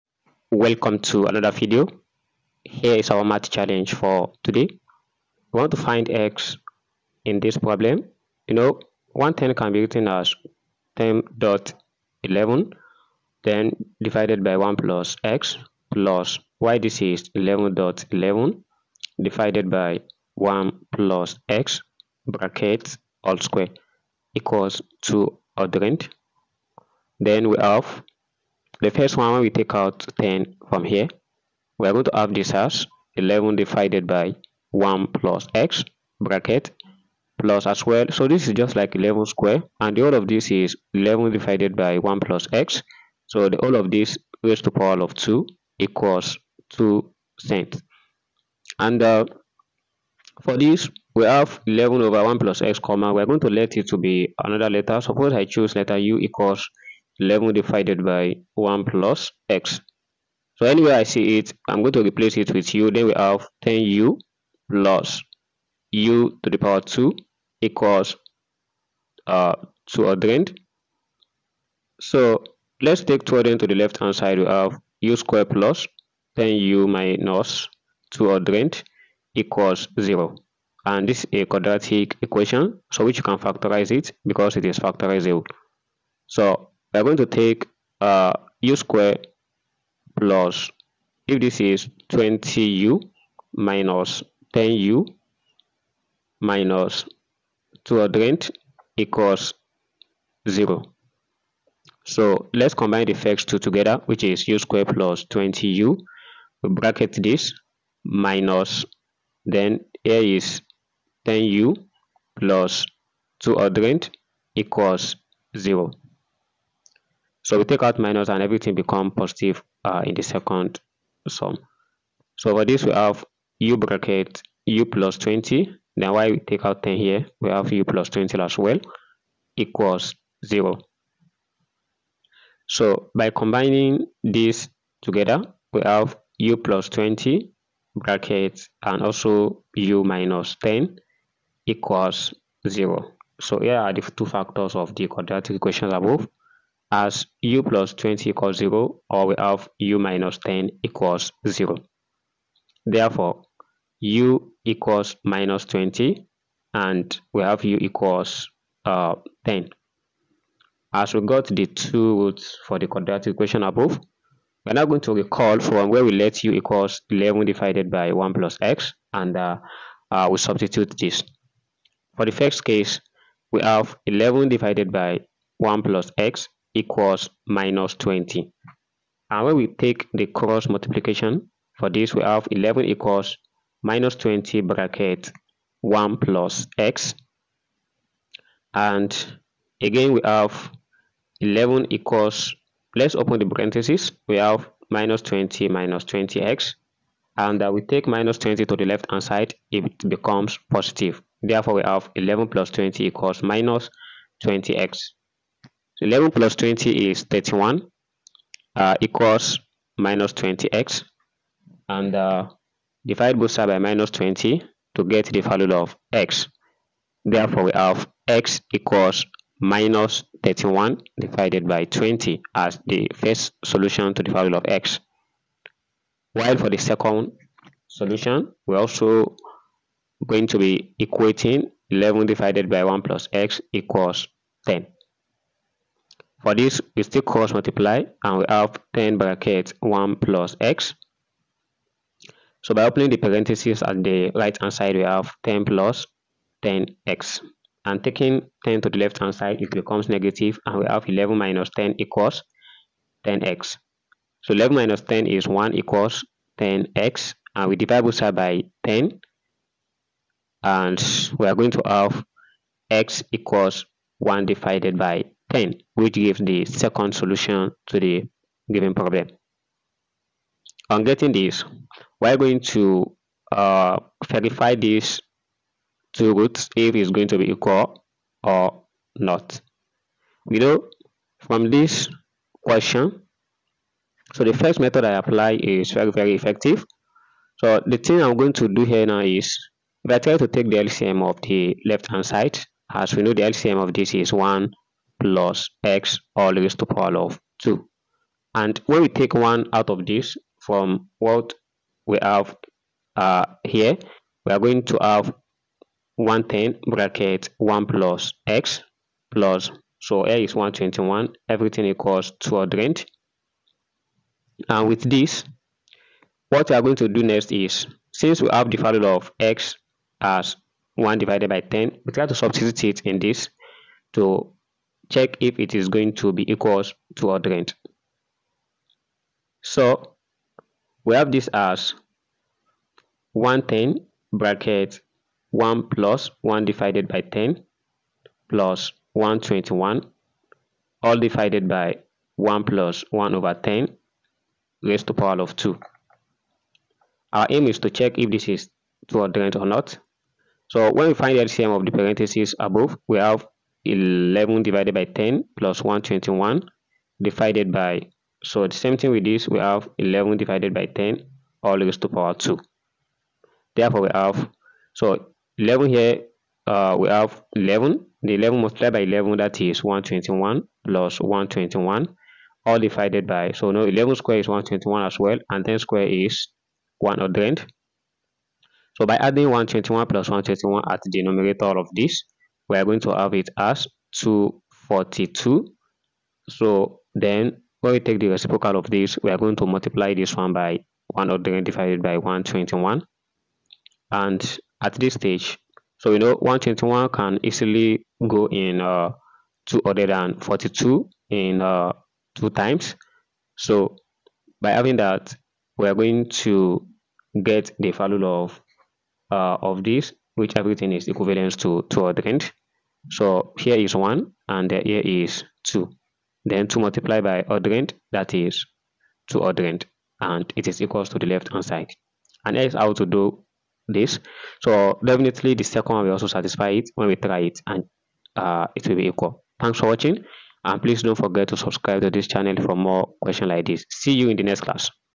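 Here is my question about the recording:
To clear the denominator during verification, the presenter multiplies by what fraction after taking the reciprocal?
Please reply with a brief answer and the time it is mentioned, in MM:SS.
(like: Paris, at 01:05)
100/121, at 06:31.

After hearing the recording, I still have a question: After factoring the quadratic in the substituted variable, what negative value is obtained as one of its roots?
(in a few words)
-20.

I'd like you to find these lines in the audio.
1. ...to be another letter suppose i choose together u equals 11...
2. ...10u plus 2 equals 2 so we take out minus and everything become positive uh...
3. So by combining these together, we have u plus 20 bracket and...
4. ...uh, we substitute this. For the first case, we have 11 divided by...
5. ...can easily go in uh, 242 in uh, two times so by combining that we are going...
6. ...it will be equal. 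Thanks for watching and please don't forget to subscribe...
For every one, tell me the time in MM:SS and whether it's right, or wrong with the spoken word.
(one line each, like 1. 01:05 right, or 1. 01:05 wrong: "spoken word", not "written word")
1. 00:53 wrong: "letter", not "together"
2. 01:51 wrong: "0", not "2"
3. 02:12 right
4. 02:50 right
5. 06:37 wrong: "having", not "combining"
6. 07:08 right.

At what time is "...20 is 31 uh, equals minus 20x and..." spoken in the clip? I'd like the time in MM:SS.
03:26.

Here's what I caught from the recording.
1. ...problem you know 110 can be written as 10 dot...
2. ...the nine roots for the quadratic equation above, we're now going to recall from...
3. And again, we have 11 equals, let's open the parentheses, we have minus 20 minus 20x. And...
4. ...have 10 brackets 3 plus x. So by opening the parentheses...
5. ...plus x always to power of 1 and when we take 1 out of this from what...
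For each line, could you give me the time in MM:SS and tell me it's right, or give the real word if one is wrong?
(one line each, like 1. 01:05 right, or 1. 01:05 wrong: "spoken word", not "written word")
1. 00:07 right
2. 02:41 wrong: "two", not "nine"
3. 03:08 right
4. 03:58 wrong: "1", not "3"
5. 04:55 wrong: "2", not "1".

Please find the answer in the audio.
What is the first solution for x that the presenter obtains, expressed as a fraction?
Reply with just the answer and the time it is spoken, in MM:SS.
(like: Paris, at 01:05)
-31/20, at 03:39.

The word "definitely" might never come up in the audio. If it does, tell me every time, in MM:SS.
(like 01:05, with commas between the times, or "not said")
07:05.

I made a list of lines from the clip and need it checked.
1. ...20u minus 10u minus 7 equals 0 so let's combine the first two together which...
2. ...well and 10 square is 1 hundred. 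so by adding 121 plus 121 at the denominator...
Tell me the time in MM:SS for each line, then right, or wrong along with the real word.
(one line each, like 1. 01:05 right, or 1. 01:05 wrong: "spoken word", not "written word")
1. 01:32 wrong: "2", not "7"
2. 06:15 right.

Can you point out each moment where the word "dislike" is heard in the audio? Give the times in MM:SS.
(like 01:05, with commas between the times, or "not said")
not said.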